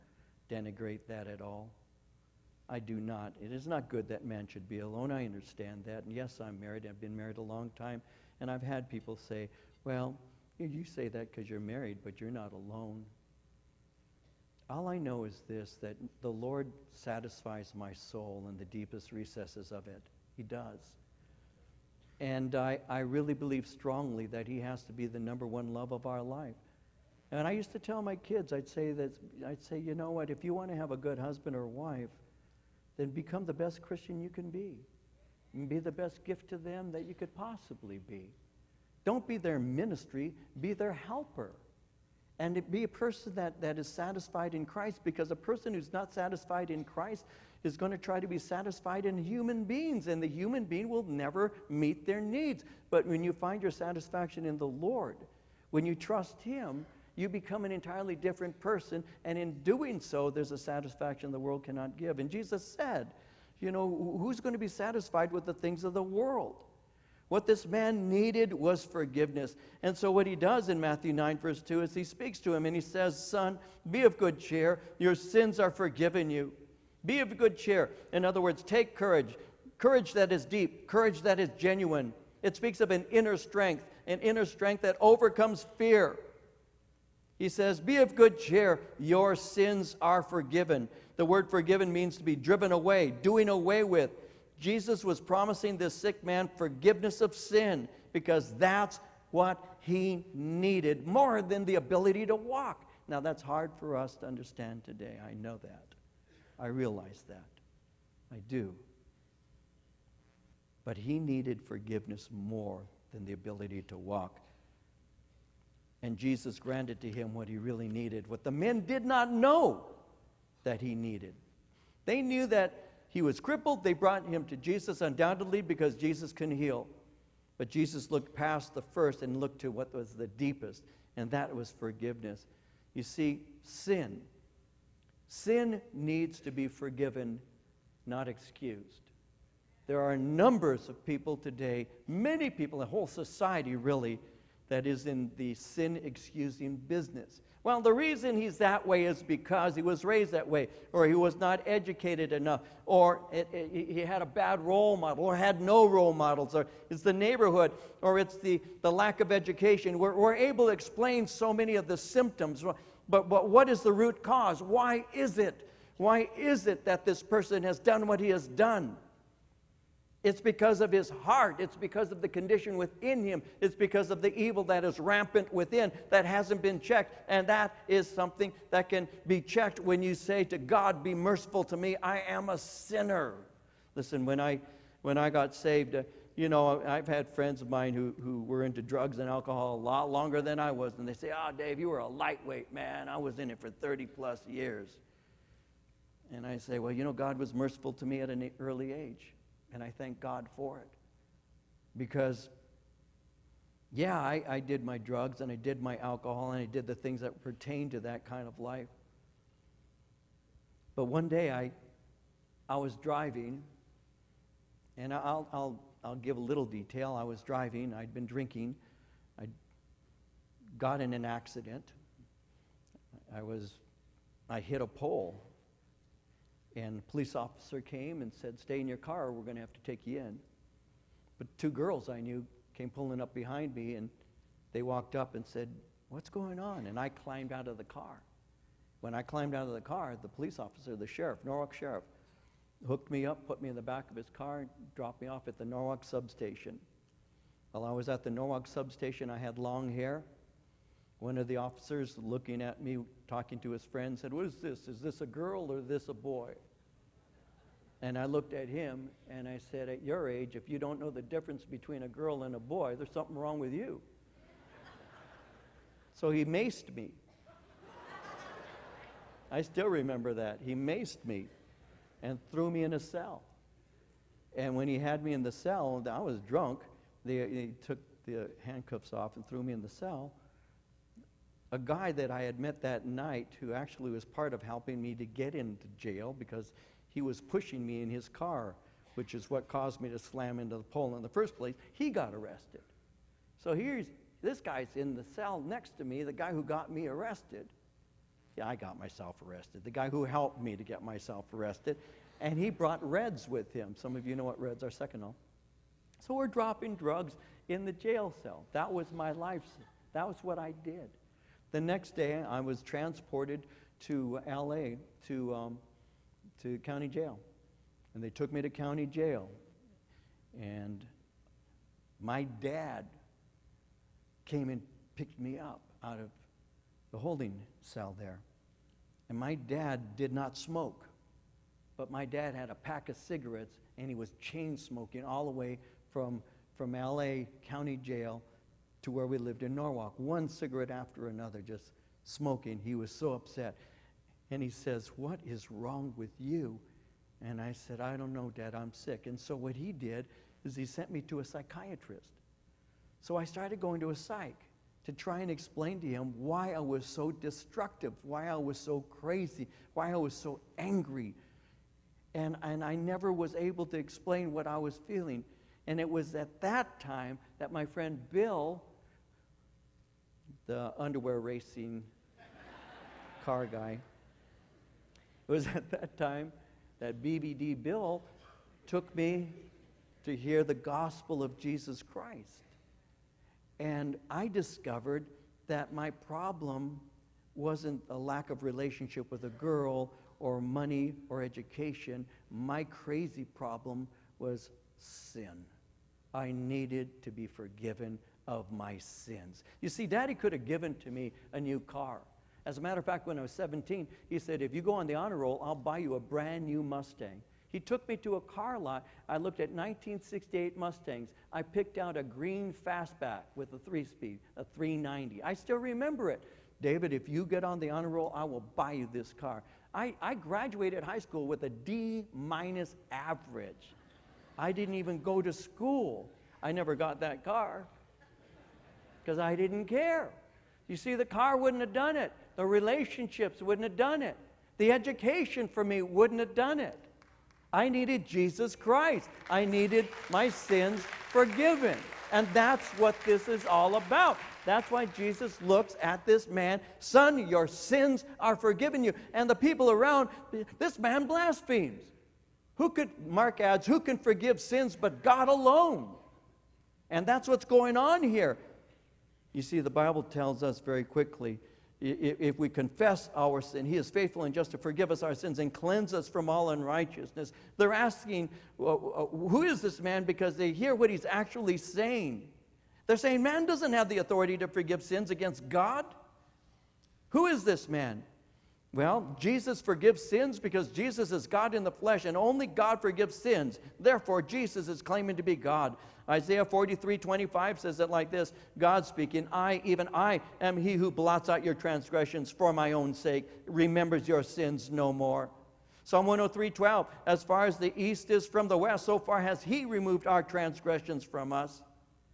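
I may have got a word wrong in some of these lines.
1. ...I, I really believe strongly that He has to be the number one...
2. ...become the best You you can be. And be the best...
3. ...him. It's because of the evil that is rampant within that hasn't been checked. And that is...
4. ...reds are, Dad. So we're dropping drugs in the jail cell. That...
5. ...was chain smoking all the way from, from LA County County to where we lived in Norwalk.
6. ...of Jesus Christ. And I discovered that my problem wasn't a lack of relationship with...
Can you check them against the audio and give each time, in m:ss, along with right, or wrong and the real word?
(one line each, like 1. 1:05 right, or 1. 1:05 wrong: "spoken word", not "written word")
1. 0:22 right
2. 0:33 wrong: "Christian", not "You"
3. 2:53 right
4. 5:04 wrong: "Seconal", not "Dad"
5. 5:34 wrong: "Jail", not "County"
6. 6:21 right.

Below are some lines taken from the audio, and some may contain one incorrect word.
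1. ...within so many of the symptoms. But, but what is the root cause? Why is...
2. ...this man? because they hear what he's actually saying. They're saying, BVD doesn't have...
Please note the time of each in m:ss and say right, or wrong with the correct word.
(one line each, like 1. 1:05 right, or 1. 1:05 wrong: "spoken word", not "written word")
1. 2:40 wrong: "explain", not "within"
2. 7:49 wrong: "Man", not "BVD".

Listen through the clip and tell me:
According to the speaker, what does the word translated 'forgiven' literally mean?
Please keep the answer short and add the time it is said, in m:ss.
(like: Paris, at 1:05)
To be driven away, at 1:32.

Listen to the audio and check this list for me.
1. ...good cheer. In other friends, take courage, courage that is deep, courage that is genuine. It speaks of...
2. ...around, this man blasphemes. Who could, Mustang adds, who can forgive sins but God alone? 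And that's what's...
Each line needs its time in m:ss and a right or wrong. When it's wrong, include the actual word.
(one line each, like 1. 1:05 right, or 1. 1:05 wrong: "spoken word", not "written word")
1. 1:17 wrong: "words", not "friends"
2. 7:29 wrong: "Mark", not "Mustang".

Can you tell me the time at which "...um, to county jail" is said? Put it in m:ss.
5:15.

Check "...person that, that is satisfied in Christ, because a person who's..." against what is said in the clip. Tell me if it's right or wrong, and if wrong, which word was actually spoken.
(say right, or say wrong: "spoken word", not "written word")
right.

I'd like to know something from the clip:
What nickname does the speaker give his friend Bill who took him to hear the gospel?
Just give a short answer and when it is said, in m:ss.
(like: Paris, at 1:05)
BVD Bill, at 6:17.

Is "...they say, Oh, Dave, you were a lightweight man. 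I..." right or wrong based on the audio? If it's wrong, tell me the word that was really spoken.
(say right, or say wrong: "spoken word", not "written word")
right.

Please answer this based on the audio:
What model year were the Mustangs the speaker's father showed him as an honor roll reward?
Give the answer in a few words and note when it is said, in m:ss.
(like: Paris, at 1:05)
1968, at 6:49.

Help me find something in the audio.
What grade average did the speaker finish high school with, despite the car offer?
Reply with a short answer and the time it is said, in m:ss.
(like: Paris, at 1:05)
D minus, at 7:01.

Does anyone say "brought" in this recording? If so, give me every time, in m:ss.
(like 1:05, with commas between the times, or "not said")
2:03, 5:02.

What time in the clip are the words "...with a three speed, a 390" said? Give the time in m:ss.
6:53.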